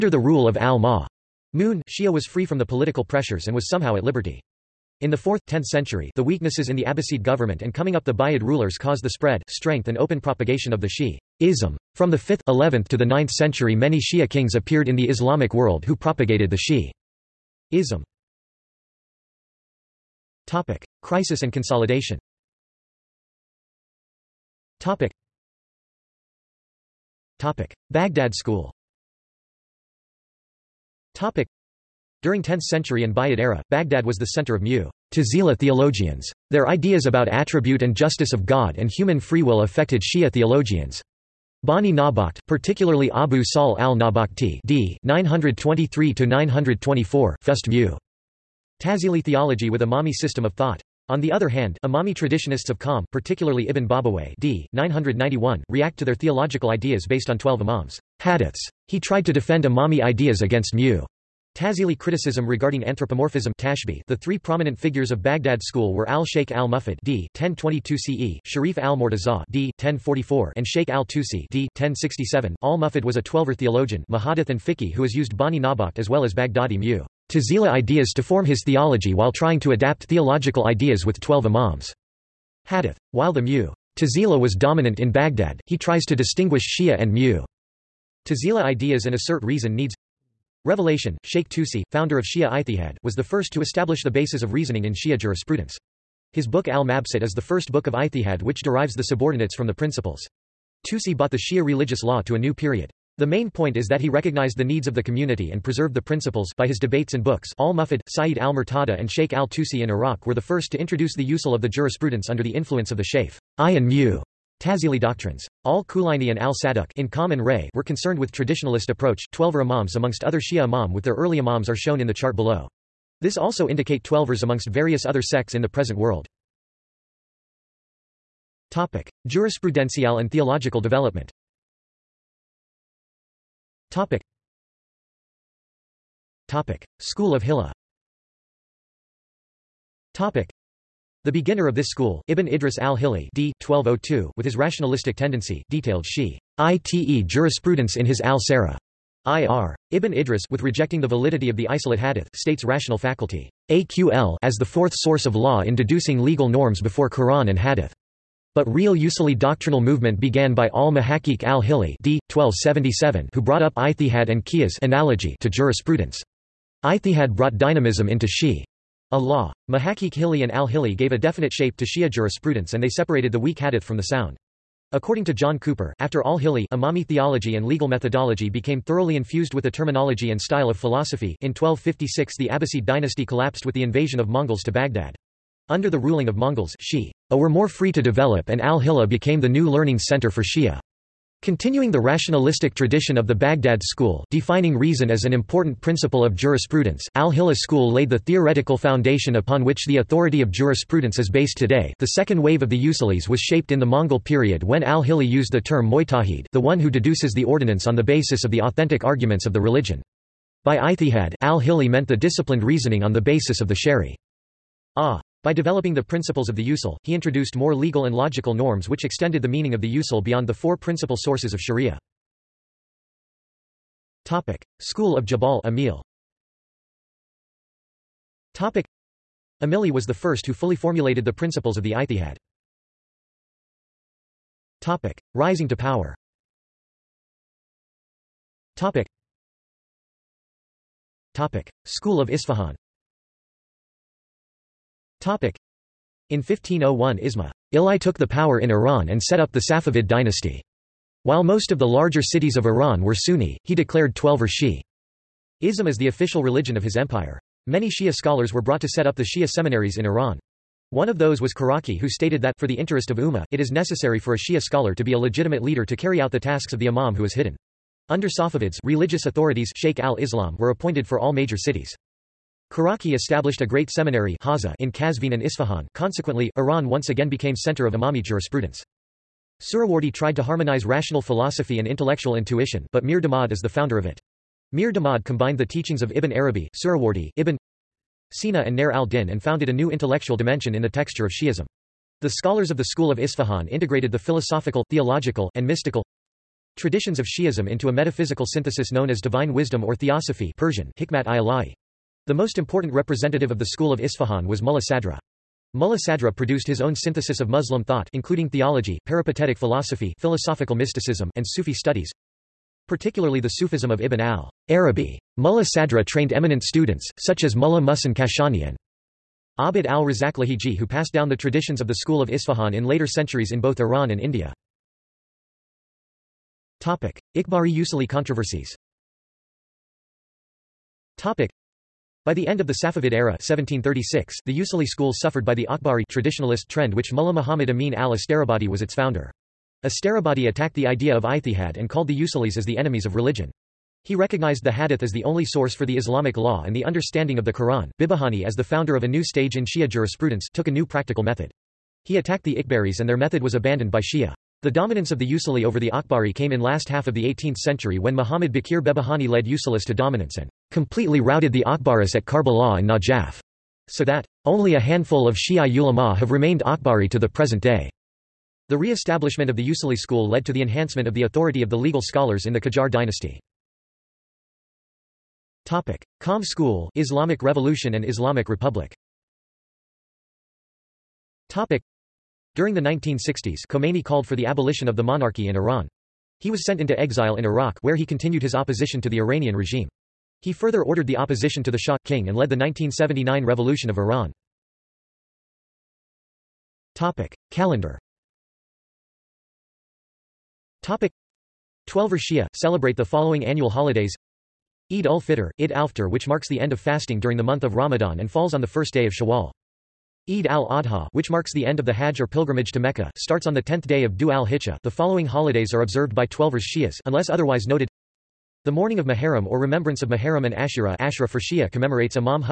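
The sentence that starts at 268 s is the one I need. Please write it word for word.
Under Safavids, religious authorities Sheikh al-Islam were appointed for all major cities.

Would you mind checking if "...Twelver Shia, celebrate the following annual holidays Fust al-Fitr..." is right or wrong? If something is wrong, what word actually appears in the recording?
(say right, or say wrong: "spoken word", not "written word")
wrong: "Eid", not "Fust".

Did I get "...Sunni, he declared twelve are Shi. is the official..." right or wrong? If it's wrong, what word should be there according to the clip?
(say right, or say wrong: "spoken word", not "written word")
right.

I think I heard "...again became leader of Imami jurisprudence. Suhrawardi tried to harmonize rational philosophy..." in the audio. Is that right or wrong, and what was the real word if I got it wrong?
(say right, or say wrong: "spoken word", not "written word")
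wrong: "center", not "leader".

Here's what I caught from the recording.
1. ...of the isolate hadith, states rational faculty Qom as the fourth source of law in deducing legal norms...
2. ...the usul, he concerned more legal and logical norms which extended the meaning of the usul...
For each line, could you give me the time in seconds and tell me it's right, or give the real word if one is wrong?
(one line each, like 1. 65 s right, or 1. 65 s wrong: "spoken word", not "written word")
1. 151 s wrong: "AQL", not "Qom"
2. 216 s wrong: "introduced", not "concerned".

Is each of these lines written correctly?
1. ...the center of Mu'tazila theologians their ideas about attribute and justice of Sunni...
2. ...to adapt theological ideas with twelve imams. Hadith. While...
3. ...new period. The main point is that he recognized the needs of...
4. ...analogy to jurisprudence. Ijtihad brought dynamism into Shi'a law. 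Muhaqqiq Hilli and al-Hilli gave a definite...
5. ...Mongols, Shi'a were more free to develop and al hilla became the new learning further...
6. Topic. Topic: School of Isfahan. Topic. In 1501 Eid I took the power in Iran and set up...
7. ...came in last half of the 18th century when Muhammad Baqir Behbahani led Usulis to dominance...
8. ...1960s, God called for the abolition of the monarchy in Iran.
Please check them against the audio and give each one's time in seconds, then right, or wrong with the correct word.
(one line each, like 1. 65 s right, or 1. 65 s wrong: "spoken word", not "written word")
1. 34 s wrong: "God", not "Sunni"
2. 79 s right
3. 102 s right
4. 164 s right
5. 186 s wrong: "center", not "further"
6. 238 s wrong: "Ismail", not "Eid"
7. 356 s right
8. 382 s wrong: "Khomeini", not "God".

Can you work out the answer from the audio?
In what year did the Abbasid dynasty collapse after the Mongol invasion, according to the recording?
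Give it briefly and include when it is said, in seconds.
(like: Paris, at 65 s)
1256, at 181 s.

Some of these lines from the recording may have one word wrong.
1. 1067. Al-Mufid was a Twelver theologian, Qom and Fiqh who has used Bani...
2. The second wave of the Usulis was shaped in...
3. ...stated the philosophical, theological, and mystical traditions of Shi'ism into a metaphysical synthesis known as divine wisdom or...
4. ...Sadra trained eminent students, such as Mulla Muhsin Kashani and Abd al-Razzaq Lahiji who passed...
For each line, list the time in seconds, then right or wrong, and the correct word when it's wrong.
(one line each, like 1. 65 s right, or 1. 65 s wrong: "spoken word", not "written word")
1. 71 s wrong: "Mahadith", not "Qom"
2. 201 s right
3. 293 s wrong: "integrated", not "stated"
4. 315 s right.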